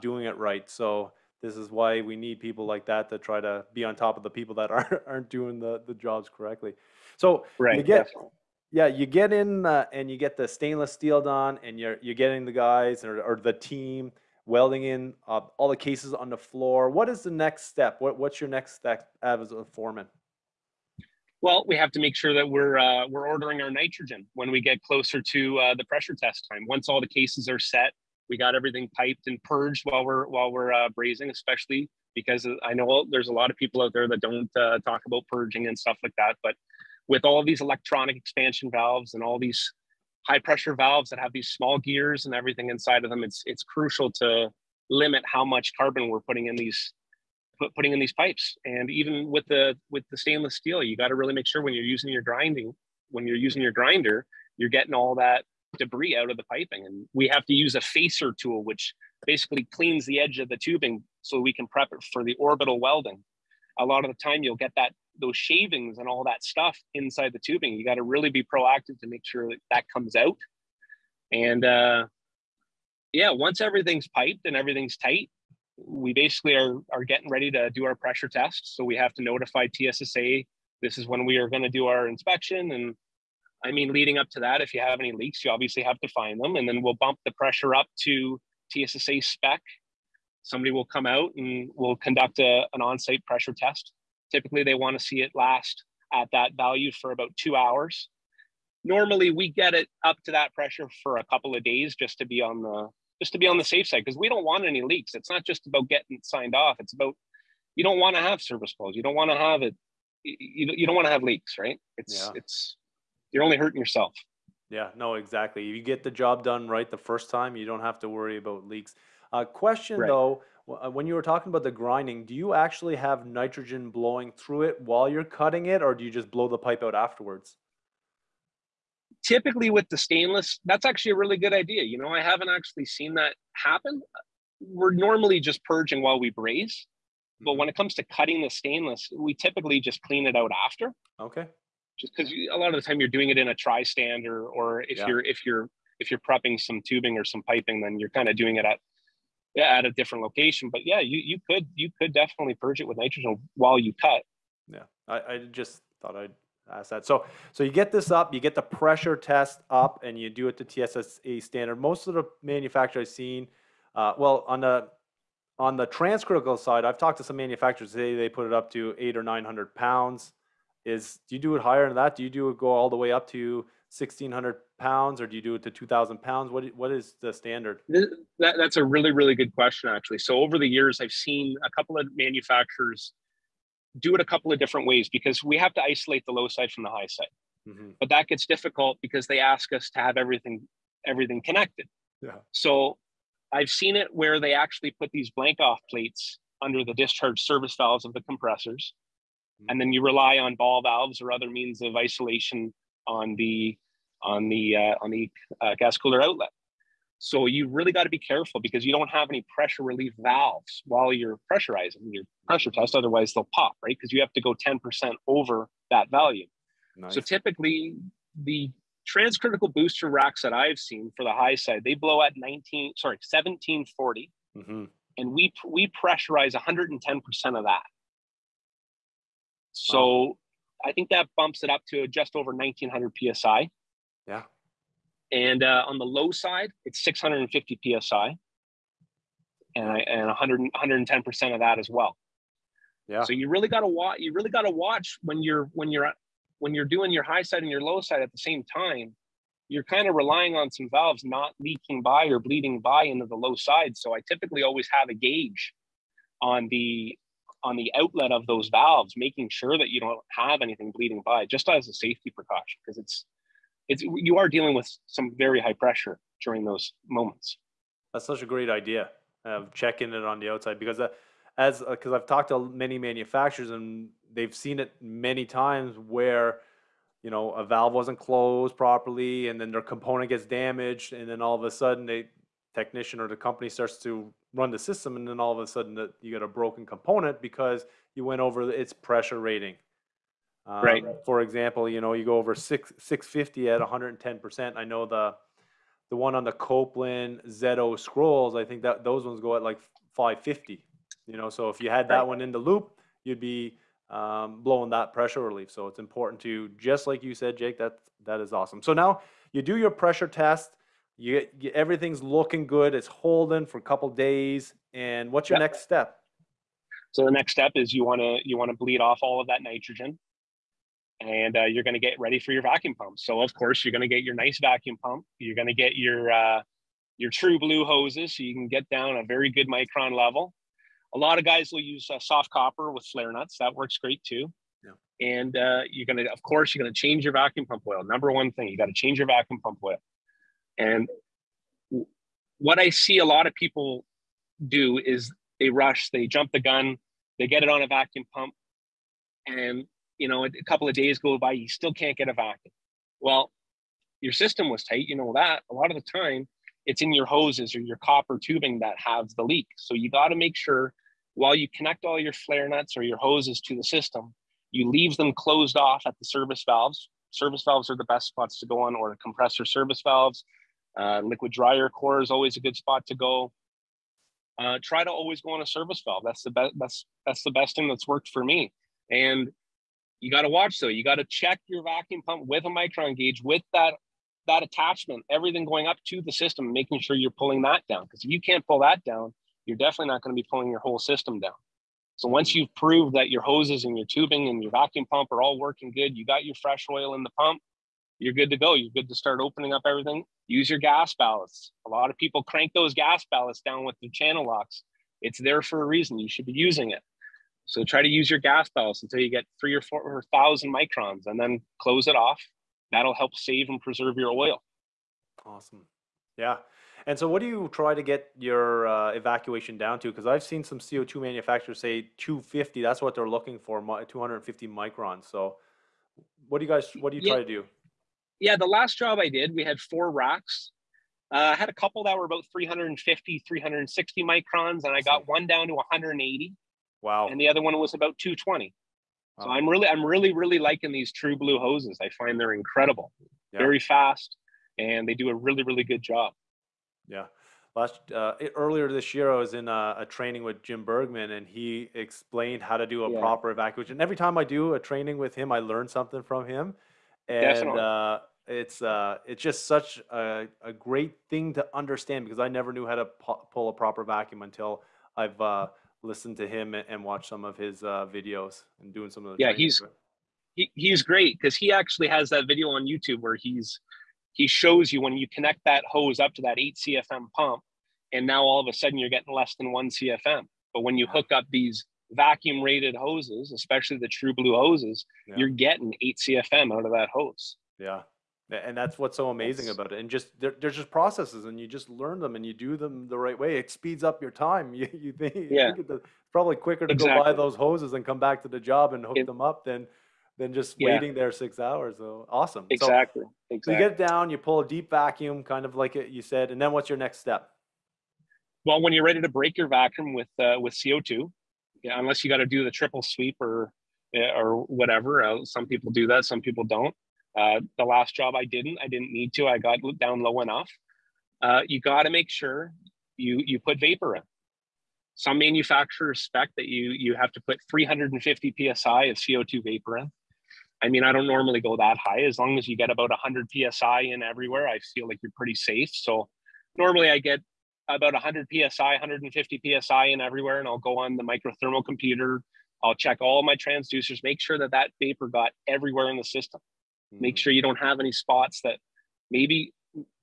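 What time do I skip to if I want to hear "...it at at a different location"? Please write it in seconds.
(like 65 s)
148 s.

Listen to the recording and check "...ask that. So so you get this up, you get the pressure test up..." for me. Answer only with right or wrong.
right.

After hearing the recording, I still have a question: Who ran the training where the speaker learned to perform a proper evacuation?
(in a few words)
Jim Bergman.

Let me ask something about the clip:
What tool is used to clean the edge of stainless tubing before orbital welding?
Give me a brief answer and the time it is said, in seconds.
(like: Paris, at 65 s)
facer tool, at 57 s.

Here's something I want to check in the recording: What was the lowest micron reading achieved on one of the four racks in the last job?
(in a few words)
180.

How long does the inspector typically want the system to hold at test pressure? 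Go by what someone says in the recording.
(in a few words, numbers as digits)
about two hours.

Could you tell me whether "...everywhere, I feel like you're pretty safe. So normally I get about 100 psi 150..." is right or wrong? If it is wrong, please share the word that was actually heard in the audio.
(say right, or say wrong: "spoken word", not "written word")
right.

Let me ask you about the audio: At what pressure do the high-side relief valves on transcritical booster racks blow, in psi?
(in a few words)
1740.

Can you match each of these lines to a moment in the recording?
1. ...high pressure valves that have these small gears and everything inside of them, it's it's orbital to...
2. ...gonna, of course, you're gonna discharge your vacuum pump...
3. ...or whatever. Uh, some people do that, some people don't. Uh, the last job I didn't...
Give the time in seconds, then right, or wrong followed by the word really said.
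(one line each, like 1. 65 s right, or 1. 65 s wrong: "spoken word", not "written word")
1. 40 s wrong: "crucial", not "orbital"
2. 336 s wrong: "change", not "discharge"
3. 514 s right.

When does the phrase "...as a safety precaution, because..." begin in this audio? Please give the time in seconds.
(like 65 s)
261 s.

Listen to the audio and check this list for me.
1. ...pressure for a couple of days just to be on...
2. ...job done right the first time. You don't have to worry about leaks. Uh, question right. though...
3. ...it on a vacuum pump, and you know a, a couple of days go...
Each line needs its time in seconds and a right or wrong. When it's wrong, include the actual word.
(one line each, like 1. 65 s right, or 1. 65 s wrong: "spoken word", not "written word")
1. 100 s right
2. 116 s right
3. 347 s right.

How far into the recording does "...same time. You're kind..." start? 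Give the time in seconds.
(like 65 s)
248 s.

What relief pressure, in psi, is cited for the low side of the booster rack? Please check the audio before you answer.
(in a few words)
650 psi.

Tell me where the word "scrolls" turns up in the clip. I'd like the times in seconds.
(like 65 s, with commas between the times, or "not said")
297 s.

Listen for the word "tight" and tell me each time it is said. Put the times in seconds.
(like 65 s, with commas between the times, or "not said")
74 s, 354 s.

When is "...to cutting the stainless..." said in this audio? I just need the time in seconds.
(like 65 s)
137 s.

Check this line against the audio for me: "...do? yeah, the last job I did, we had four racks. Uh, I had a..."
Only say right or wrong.
right.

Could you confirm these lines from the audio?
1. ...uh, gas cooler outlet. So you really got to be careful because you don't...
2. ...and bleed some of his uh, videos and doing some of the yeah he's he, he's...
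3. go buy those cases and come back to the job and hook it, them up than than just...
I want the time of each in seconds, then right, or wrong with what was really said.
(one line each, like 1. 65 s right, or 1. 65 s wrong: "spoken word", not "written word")
1. 205 s right
2. 466 s wrong: "watched", not "bleed"
3. 497 s wrong: "hoses", not "cases".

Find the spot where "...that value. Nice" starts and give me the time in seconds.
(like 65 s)
215 s.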